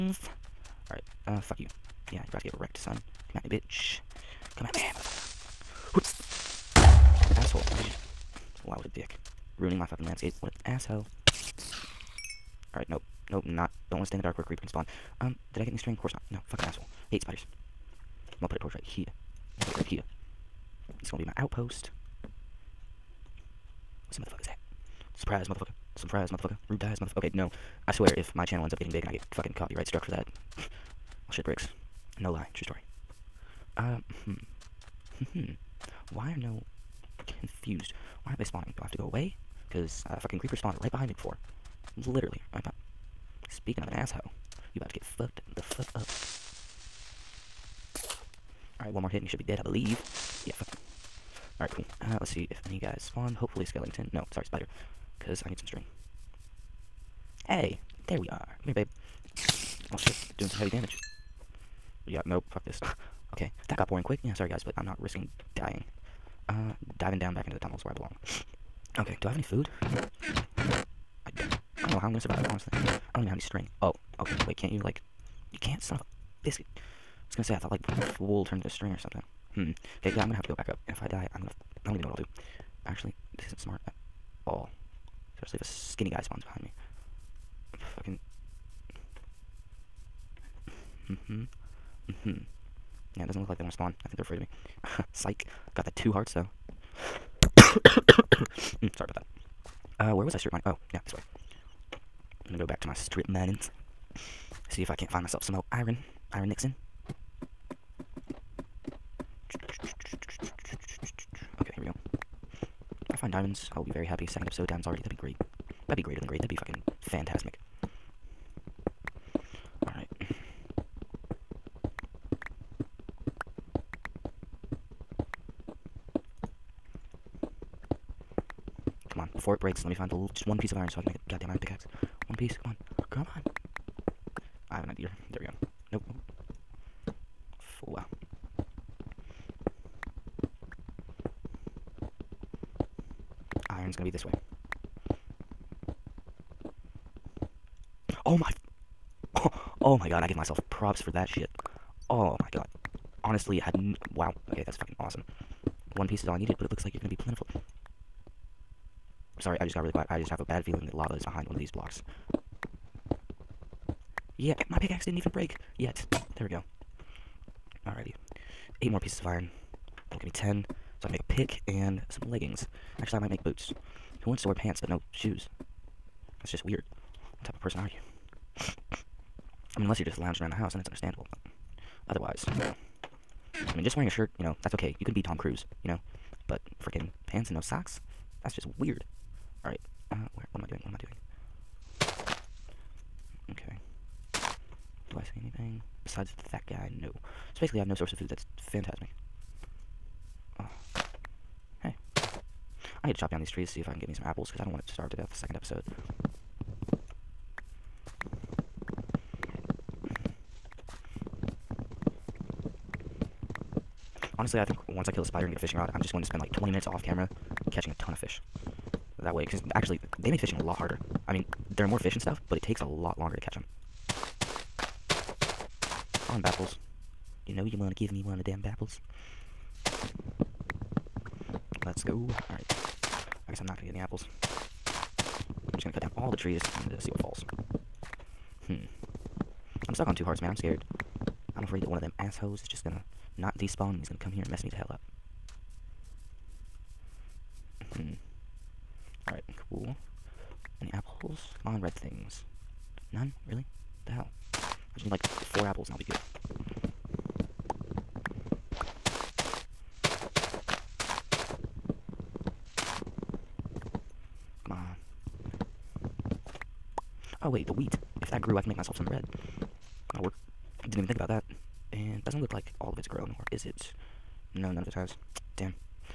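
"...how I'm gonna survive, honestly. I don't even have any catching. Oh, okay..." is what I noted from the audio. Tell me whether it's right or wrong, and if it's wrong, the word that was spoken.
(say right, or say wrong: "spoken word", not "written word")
wrong: "string", not "catching".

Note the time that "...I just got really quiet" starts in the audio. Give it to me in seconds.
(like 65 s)
159 s.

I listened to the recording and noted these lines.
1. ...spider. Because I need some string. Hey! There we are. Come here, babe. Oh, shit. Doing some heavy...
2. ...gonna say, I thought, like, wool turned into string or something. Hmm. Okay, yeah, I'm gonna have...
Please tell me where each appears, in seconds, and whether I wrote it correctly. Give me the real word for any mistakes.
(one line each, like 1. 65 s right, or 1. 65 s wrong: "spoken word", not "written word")
1. 54 s right
2. 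77 s right.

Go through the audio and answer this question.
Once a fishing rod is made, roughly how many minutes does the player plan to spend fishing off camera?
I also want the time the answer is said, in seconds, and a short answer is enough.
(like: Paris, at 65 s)
20, at 216 s.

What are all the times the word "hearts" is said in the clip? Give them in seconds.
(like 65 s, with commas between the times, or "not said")
96 s, 240 s.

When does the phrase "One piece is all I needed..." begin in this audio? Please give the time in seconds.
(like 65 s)
155 s.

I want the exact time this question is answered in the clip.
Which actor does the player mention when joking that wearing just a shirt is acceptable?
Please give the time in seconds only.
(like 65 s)
185 s.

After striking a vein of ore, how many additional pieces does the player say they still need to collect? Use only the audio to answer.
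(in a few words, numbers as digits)
8.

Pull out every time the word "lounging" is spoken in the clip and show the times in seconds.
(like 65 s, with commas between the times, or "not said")
180 s.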